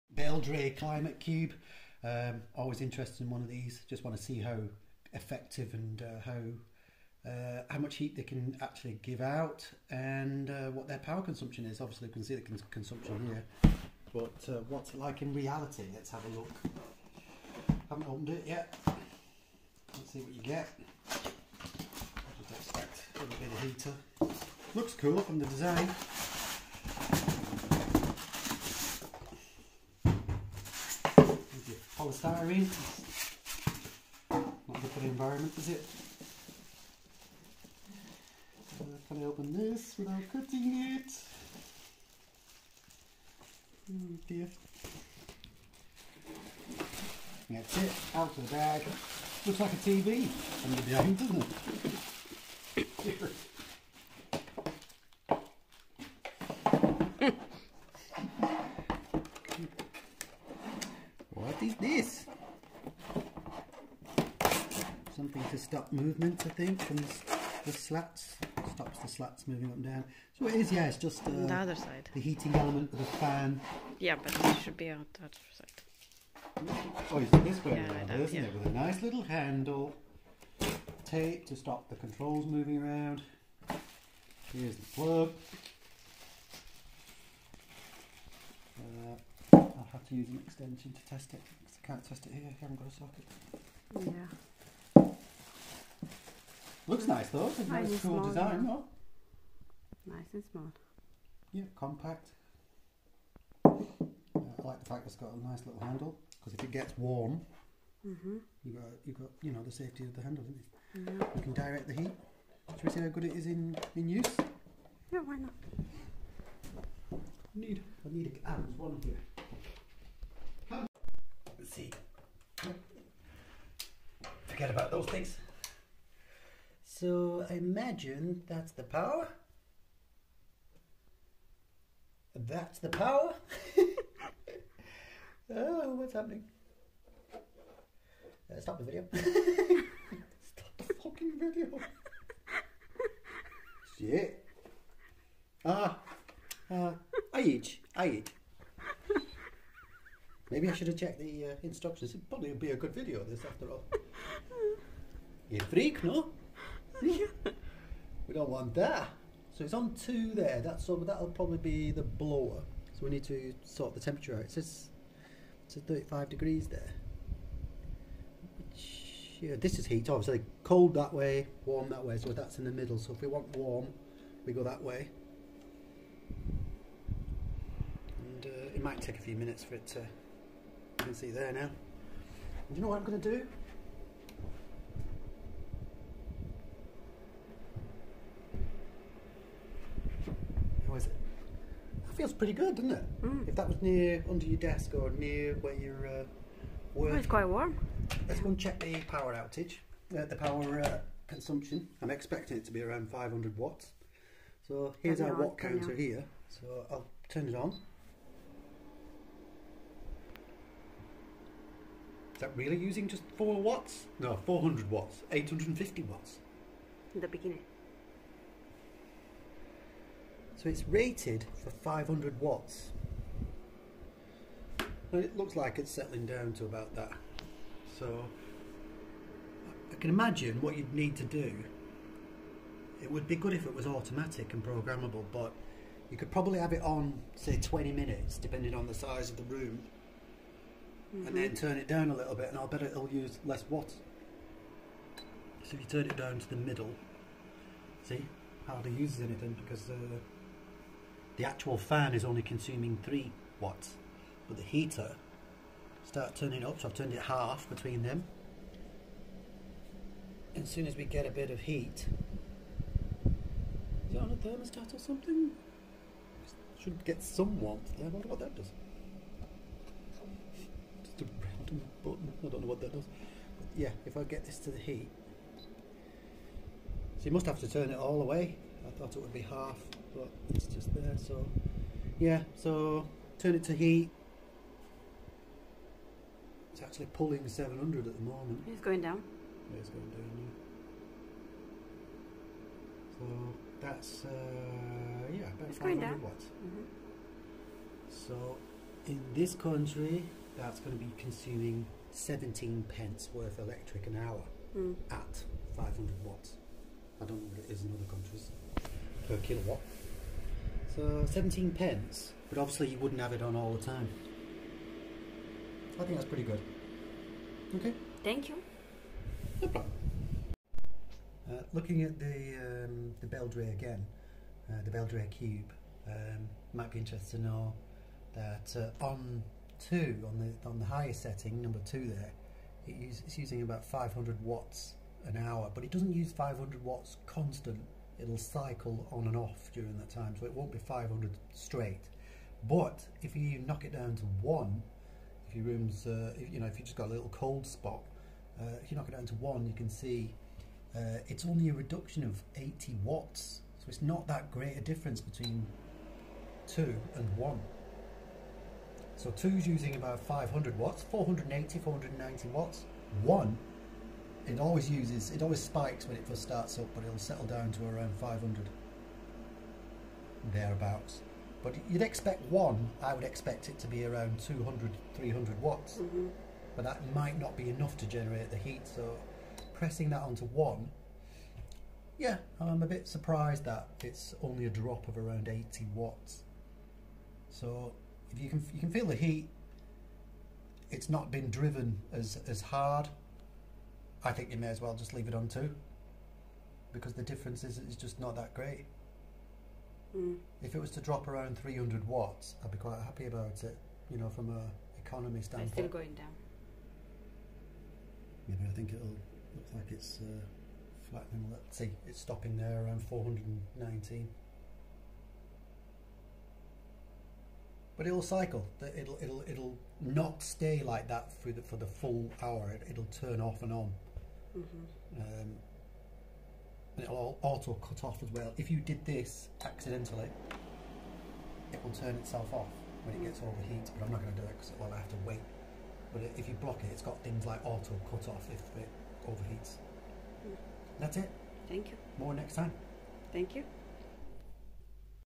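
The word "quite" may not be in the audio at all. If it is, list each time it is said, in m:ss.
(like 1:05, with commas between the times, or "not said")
3:17, 6:42.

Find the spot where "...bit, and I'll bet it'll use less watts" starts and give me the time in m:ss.
4:02.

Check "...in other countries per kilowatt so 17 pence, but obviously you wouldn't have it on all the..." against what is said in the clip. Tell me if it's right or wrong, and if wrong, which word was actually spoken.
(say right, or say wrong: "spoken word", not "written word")
right.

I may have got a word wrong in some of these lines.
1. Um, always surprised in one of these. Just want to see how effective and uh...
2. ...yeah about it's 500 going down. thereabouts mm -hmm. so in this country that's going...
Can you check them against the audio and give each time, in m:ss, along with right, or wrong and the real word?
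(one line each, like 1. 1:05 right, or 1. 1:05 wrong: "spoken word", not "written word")
1. 0:02 wrong: "interested", not "surprised"
2. 4:55 wrong: "watts", not "thereabouts".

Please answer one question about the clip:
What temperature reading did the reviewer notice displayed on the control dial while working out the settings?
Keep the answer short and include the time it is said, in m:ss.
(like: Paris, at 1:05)
35 degrees, at 2:45.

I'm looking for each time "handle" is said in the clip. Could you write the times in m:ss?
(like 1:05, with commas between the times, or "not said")
1:19, 1:45, 1:50.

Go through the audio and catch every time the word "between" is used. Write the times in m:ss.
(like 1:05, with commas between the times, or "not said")
4:17, 5:55.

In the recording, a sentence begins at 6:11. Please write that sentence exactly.
But you'd expect one, I would expect it to be around 200, 300 watts, mm -hmm.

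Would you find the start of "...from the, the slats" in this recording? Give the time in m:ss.
1:06.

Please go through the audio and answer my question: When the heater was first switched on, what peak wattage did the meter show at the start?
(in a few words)
850 watts.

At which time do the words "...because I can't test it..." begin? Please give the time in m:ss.
1:31.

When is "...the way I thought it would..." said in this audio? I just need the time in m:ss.
4:38.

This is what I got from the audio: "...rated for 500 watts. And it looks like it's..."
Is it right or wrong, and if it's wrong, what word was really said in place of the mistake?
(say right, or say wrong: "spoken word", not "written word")
right.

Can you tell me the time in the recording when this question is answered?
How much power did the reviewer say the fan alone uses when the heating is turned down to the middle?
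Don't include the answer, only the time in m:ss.
4:13.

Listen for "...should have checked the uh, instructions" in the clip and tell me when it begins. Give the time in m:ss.
2:30.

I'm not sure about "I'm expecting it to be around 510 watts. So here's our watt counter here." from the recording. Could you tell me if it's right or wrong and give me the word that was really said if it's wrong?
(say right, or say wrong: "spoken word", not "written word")
wrong: "500", not "510".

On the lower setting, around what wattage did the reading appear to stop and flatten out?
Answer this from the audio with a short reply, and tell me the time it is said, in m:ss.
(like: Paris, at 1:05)
419, at 6:53.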